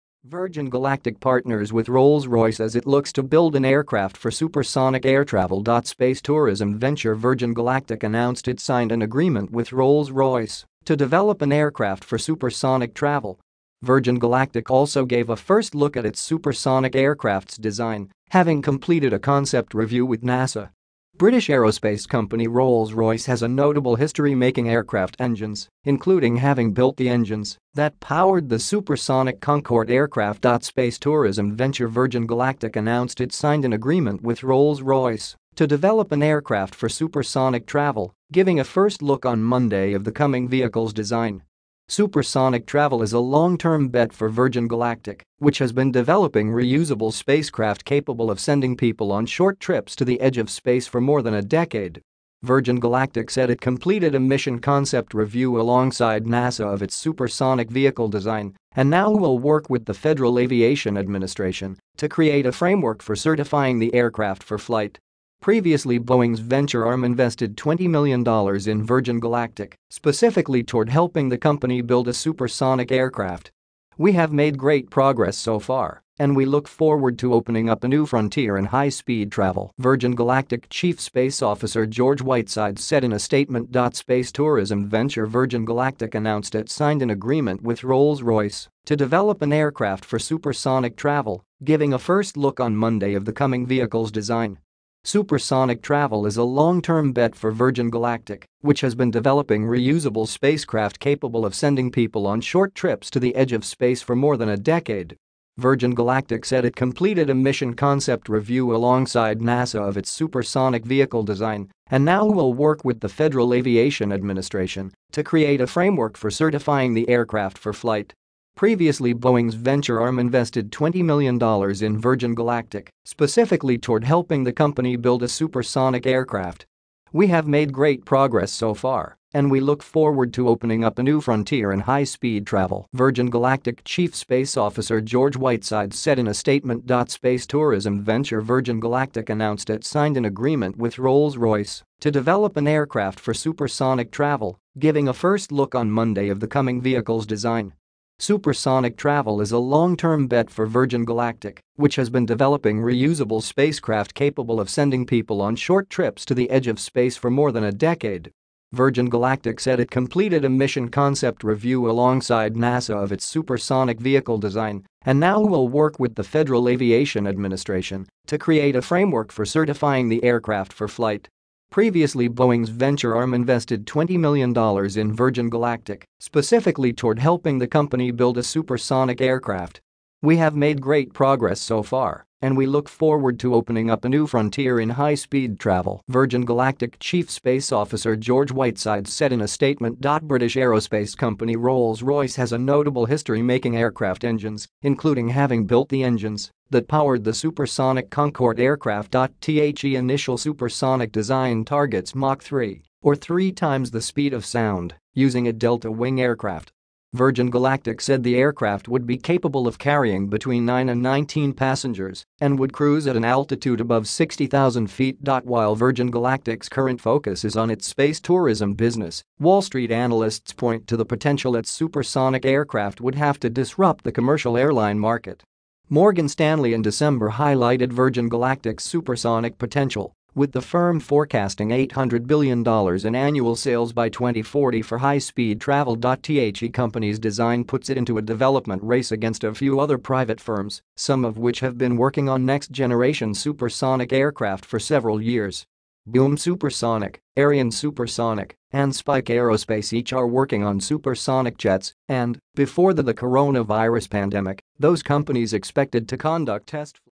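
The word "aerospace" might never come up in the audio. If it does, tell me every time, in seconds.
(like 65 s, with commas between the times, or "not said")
21 s, 190 s, 249 s.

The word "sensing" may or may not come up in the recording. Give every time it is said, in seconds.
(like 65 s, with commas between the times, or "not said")
not said.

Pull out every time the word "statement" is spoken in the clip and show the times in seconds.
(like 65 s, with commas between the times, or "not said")
83 s, 136 s, 189 s.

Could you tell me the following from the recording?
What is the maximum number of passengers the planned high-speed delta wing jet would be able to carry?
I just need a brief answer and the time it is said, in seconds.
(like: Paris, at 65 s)
19, at 211 s.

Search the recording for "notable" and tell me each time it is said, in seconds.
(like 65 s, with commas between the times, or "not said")
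23 s, 192 s.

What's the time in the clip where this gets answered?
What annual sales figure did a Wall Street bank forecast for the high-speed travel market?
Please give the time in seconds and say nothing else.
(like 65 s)
231 s.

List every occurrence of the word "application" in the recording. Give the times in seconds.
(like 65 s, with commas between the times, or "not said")
not said.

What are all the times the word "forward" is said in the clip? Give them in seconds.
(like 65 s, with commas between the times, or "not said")
76 s, 129 s, 182 s.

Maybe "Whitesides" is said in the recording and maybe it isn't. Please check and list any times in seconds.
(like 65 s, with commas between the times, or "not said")
82 s, 135 s, 188 s.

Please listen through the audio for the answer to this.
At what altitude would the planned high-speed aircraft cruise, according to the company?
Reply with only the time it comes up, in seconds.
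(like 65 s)
213 s.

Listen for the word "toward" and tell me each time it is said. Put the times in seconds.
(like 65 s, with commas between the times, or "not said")
70 s, 123 s, 176 s.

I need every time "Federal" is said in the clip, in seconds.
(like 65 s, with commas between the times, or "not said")
59 s, 113 s, 166 s.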